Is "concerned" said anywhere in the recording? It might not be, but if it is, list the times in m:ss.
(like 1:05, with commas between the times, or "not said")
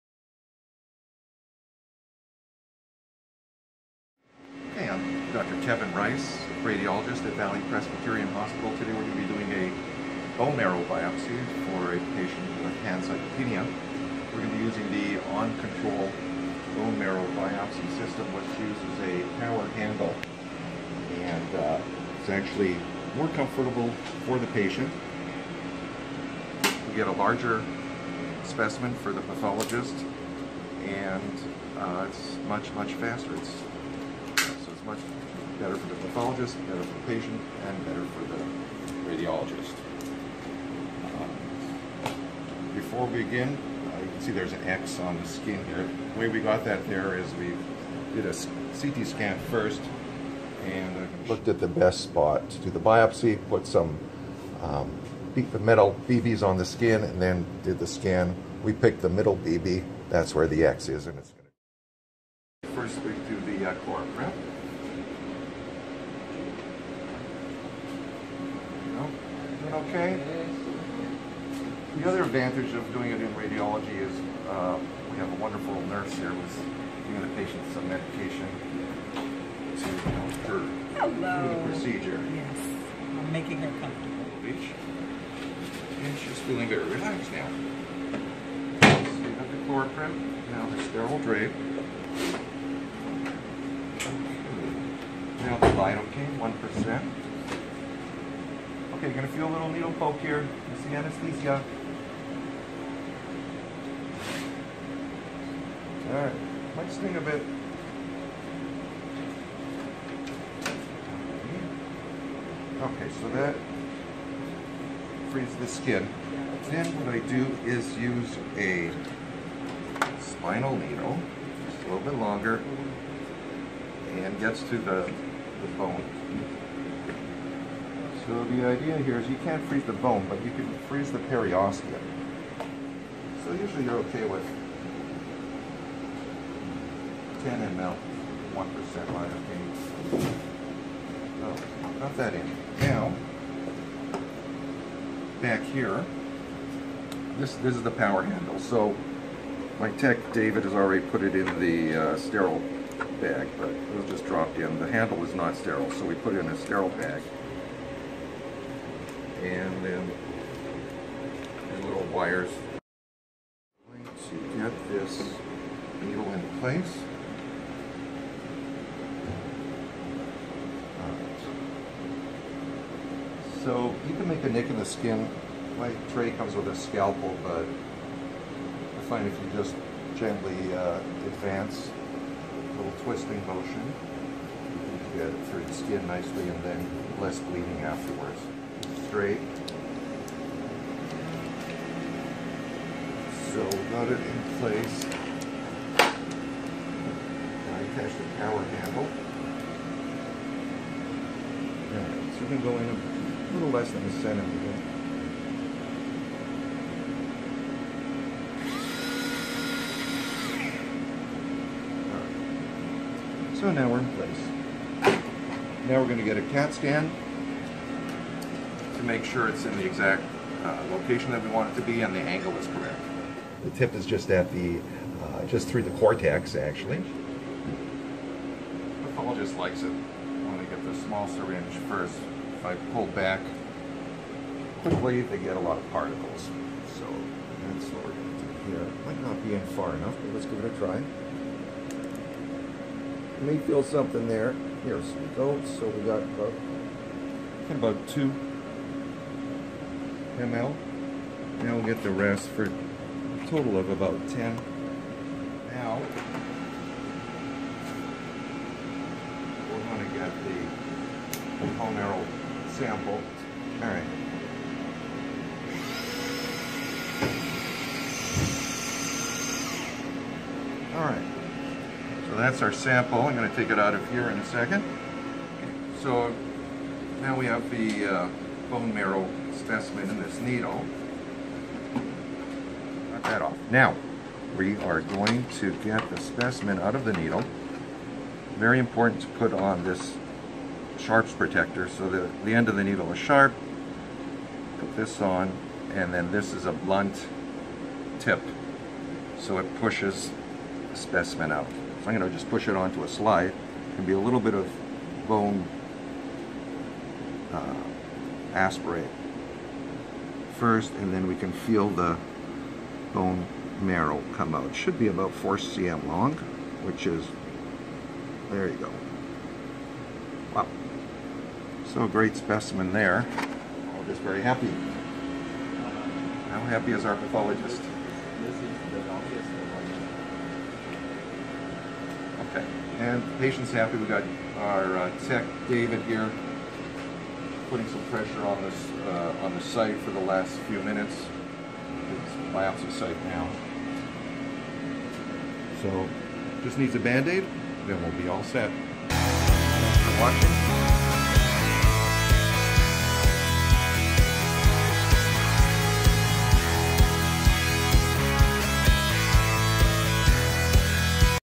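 not said.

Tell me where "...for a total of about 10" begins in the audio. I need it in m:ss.
4:12.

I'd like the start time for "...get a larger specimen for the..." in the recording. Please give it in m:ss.
0:26.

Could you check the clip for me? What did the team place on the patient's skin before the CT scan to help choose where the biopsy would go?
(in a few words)
metal BBs.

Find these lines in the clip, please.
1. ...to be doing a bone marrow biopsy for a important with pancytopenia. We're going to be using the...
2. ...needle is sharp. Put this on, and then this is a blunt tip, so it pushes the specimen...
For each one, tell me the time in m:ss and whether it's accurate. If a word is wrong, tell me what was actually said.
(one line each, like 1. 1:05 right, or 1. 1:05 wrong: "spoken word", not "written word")
1. 0:09 wrong: "patient", not "important"
2. 4:52 right.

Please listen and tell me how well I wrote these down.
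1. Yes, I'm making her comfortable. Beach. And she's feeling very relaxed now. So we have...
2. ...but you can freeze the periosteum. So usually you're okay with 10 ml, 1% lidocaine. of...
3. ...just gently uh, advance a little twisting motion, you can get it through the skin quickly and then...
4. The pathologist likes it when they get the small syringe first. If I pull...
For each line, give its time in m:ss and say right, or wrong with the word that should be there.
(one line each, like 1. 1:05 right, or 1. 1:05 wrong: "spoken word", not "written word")
1. 1:22 right
2. 2:10 right
3. 2:59 wrong: "nicely", not "quickly"
4. 3:46 right.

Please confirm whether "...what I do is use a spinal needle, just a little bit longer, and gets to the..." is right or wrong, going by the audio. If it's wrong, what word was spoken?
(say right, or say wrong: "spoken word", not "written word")
right.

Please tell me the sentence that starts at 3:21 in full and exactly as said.
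Alright, so we're going to go in a little less than a centimeter.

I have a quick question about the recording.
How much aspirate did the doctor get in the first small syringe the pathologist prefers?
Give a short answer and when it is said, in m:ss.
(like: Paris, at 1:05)
2 ml, at 4:08.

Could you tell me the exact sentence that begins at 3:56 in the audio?
So that's what we're going to do here.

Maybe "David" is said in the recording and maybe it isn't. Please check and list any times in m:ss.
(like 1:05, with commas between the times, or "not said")
2:30, 5:35.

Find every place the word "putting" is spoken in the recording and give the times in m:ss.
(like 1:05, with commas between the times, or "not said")
5:37.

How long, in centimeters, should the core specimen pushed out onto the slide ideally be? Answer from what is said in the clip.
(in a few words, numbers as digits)
4 cm.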